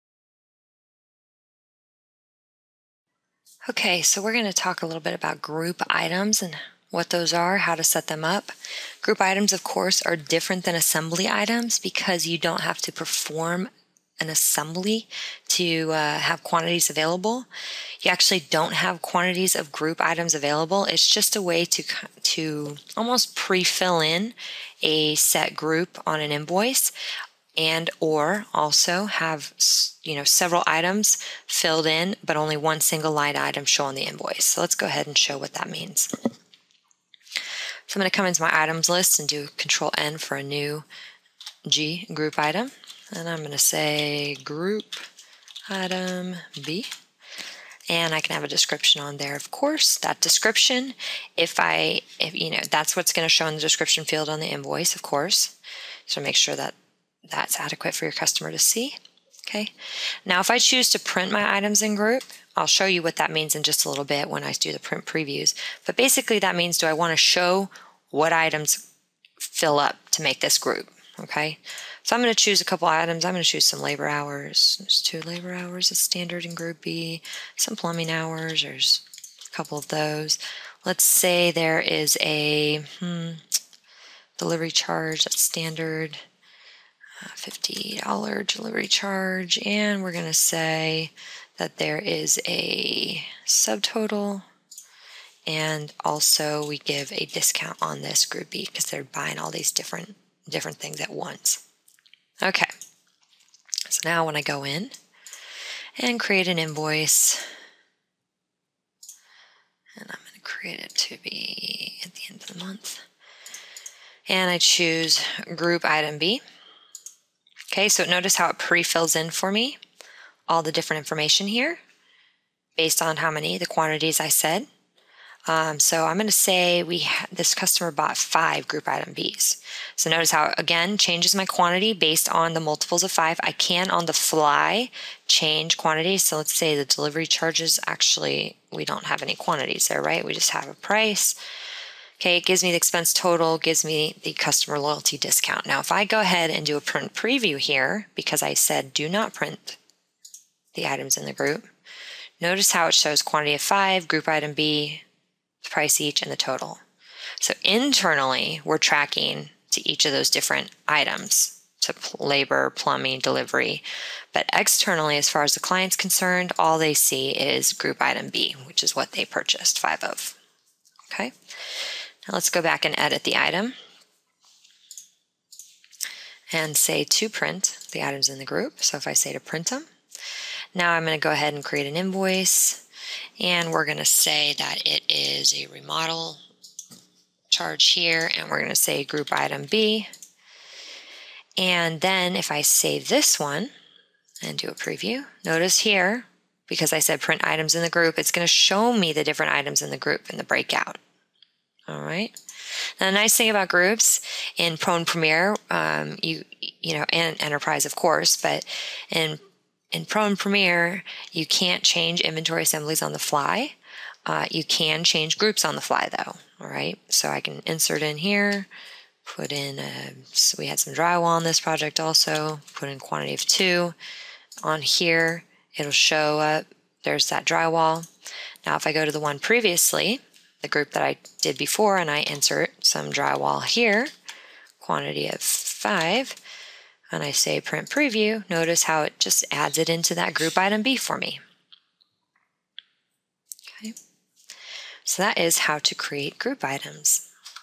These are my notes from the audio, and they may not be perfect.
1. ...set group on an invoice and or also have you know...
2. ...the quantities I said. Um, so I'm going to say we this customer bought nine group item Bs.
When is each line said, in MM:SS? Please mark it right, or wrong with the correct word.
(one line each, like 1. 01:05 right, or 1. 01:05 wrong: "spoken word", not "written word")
1. 00:25 right
2. 02:03 wrong: "five", not "nine".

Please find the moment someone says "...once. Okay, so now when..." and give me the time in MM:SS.
01:41.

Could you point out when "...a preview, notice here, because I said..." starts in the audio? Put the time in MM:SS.
03:14.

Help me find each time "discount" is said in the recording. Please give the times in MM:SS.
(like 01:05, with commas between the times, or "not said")
01:37, 02:25.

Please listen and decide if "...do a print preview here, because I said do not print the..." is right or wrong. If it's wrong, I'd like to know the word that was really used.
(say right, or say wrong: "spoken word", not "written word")
right.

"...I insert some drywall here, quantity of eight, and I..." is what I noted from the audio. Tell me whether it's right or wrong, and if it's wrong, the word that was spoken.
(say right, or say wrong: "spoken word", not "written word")
wrong: "five", not "eight".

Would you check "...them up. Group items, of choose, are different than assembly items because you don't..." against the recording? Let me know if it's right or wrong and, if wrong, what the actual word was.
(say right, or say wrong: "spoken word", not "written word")
wrong: "course", not "choose".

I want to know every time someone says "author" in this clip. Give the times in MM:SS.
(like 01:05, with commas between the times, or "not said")
not said.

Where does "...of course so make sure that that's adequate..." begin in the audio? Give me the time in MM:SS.
00:54.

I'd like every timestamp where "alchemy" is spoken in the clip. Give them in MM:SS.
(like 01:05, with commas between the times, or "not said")
not said.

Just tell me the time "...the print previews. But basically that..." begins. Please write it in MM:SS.
01:04.